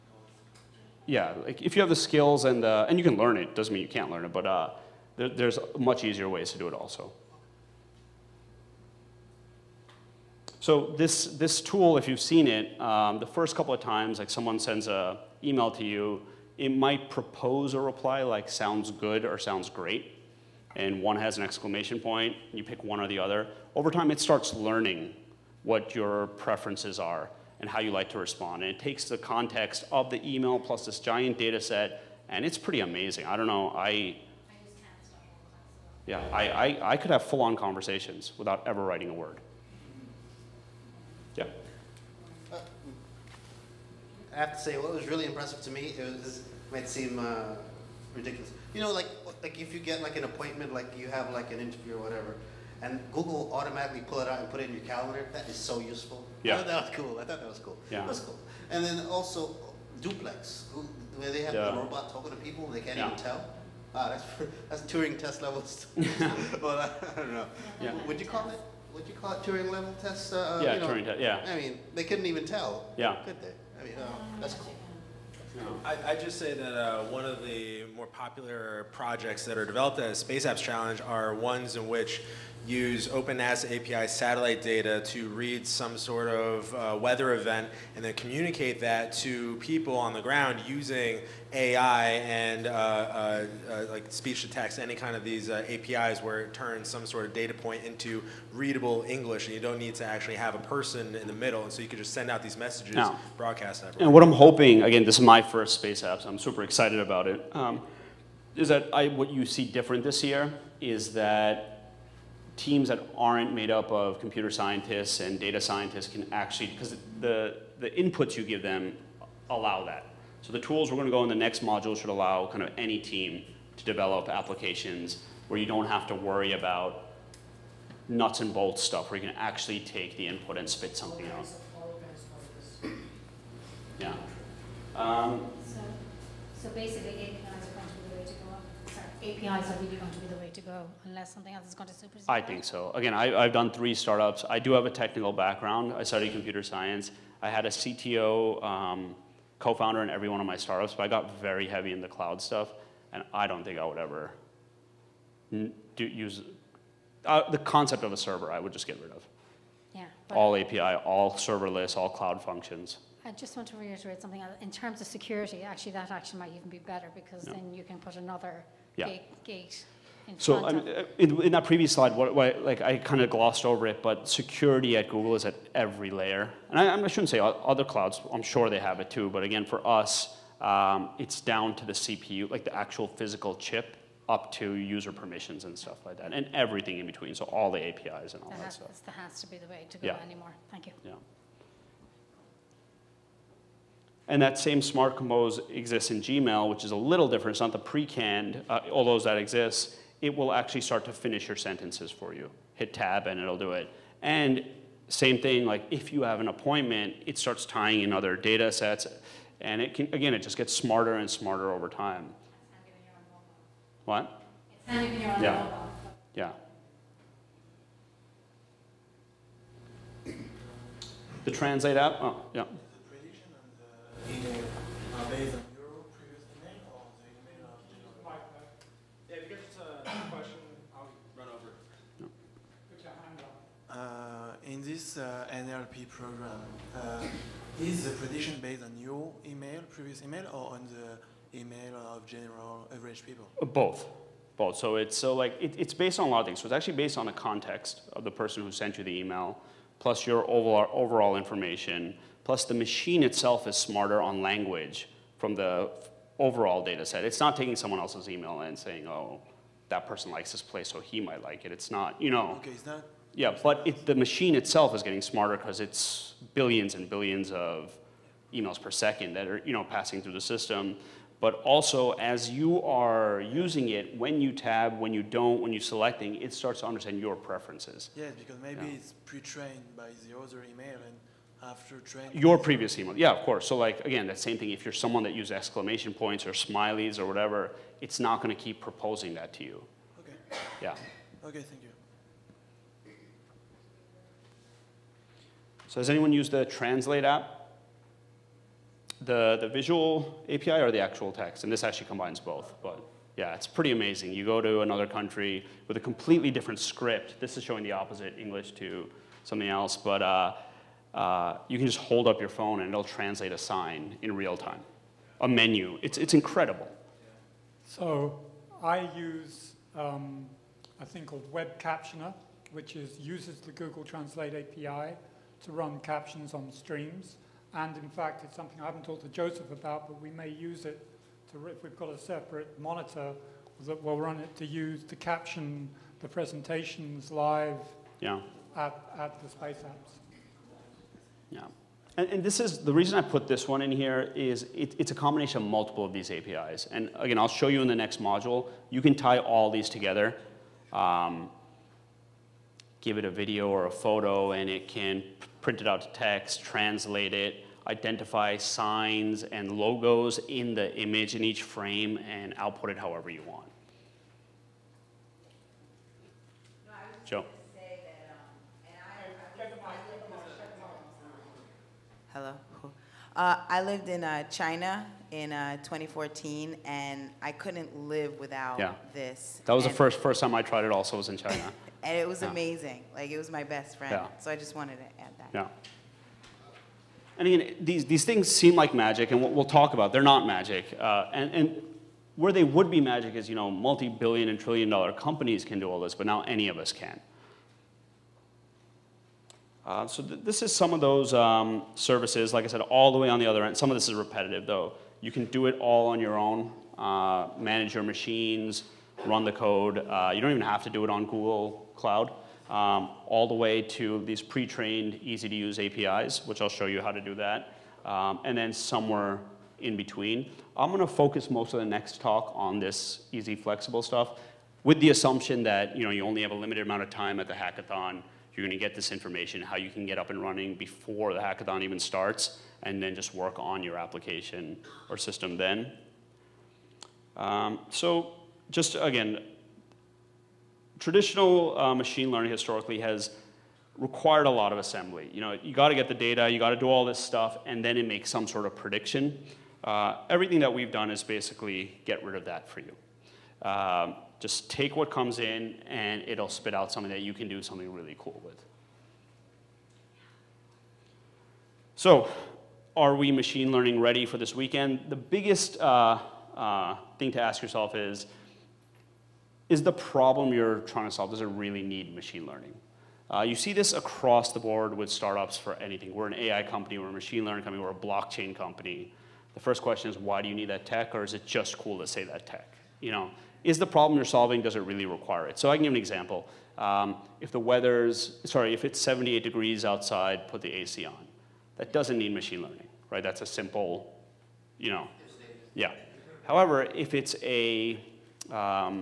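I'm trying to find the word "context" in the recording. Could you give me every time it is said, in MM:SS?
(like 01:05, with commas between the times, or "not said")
00:29, 04:07.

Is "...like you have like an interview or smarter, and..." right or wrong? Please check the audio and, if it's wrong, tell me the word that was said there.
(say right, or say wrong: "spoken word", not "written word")
wrong: "whatever", not "smarter".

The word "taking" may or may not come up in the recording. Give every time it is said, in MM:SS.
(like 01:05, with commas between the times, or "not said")
04:17.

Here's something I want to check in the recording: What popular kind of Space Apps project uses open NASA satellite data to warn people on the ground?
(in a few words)
weather event.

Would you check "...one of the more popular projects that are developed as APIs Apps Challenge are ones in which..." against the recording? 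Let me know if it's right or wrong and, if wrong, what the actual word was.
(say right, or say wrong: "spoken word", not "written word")
wrong: "Space", not "APIs".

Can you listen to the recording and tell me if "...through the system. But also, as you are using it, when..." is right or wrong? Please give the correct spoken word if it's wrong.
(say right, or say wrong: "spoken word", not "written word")
right.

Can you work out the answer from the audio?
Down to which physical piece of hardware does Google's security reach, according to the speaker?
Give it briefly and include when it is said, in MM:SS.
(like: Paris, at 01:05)
CPU, at 03:01.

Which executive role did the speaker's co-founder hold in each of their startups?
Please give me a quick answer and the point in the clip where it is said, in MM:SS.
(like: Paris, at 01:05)
CTO, at 02:27.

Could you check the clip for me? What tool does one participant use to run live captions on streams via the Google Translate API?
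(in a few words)
Web Captioner.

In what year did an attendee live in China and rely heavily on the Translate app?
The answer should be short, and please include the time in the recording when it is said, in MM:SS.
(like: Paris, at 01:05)
2014, at 06:15.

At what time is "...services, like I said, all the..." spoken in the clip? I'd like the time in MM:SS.
06:41.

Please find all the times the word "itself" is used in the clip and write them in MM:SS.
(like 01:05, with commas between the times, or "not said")
04:13, 04:24.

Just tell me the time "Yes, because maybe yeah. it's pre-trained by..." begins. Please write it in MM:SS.
04:38.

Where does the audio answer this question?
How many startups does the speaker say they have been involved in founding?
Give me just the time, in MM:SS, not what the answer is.
02:23.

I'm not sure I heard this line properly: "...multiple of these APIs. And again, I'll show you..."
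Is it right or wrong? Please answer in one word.
right.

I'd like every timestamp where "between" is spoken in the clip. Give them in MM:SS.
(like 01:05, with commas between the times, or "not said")
03:07, 06:59.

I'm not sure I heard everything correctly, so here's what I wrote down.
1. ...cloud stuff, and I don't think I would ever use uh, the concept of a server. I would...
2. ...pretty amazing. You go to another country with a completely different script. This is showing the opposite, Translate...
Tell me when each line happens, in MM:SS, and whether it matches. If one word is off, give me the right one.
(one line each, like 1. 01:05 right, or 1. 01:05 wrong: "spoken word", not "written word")
1. 02:32 right
2. 05:03 wrong: "English", not "Translate".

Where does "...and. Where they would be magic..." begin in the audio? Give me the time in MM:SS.
06:31.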